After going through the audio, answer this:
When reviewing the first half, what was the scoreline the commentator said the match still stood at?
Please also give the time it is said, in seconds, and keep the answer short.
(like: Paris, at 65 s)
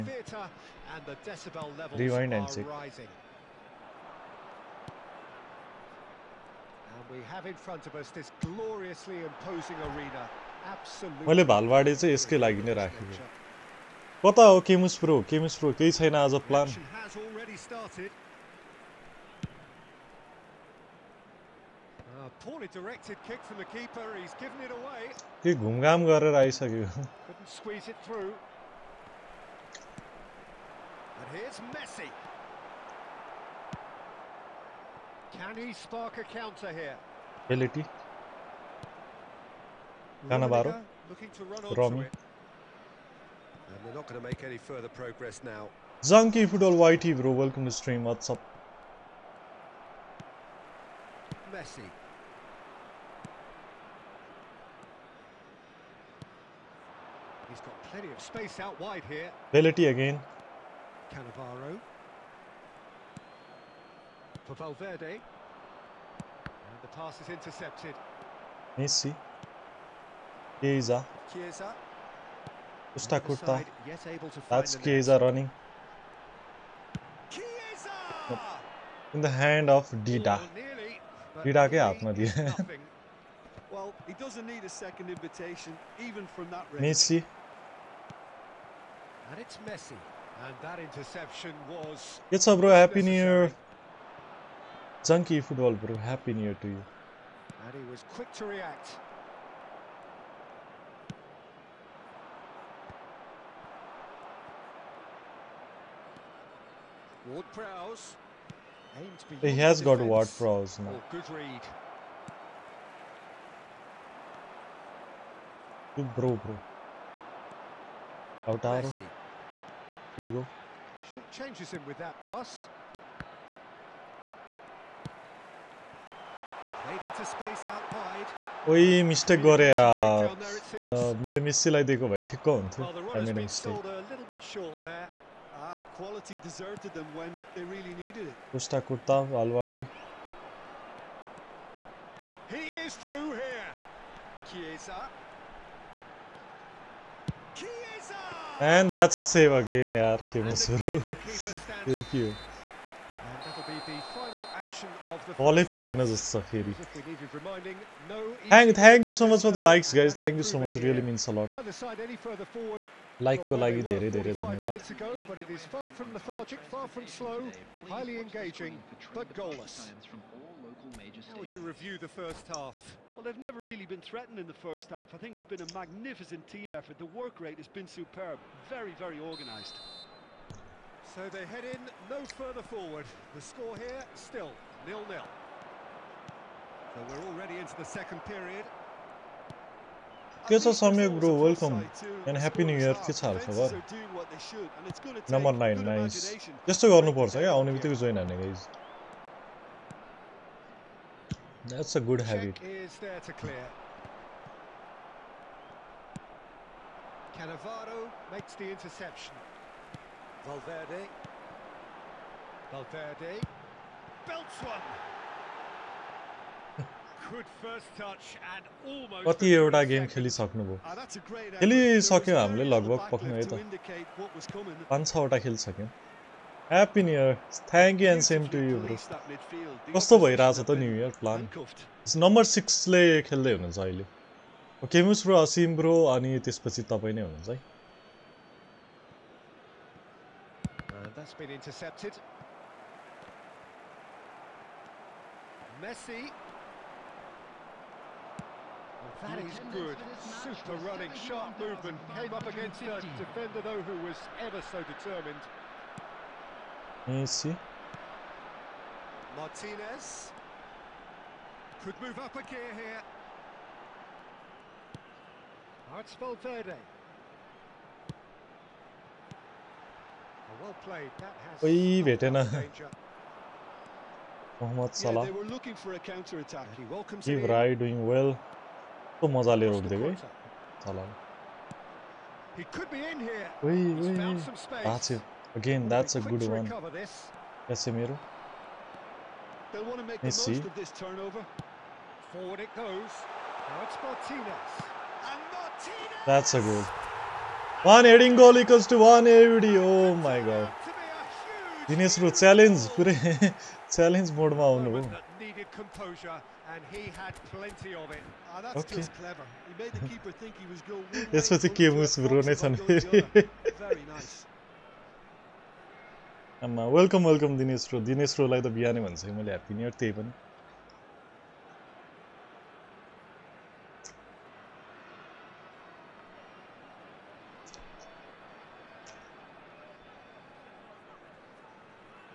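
nil-nil, at 184 s.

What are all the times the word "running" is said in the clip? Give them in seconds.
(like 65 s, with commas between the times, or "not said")
75 s, 250 s.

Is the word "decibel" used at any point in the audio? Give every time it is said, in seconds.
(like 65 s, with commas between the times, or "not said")
1 s.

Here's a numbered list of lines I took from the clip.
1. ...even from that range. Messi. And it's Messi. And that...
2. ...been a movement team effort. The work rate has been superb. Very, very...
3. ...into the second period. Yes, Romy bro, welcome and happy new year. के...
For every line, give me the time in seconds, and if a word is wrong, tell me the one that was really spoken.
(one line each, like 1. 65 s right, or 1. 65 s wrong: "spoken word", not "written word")
1. 86 s right
2. 175 s wrong: "magnificent", not "movement"
3. 187 s wrong: "Samyak", not "Romy".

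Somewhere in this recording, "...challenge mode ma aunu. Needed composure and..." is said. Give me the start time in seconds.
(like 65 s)
303 s.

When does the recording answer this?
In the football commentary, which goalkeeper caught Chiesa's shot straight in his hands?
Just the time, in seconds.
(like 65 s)
79 s.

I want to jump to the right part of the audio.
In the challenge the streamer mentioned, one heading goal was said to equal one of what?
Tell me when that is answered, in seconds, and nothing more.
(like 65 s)
298 s.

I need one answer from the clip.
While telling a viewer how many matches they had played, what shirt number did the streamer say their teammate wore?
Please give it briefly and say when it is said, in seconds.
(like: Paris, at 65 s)
6, at 232 s.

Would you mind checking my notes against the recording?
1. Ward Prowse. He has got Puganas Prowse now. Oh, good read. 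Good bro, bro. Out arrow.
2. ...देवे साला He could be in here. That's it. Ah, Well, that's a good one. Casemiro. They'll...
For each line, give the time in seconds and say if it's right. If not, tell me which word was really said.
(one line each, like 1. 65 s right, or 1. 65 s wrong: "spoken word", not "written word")
1. 107 s wrong: "Ward", not "Puganas"
2. 279 s wrong: "Again", not "Well".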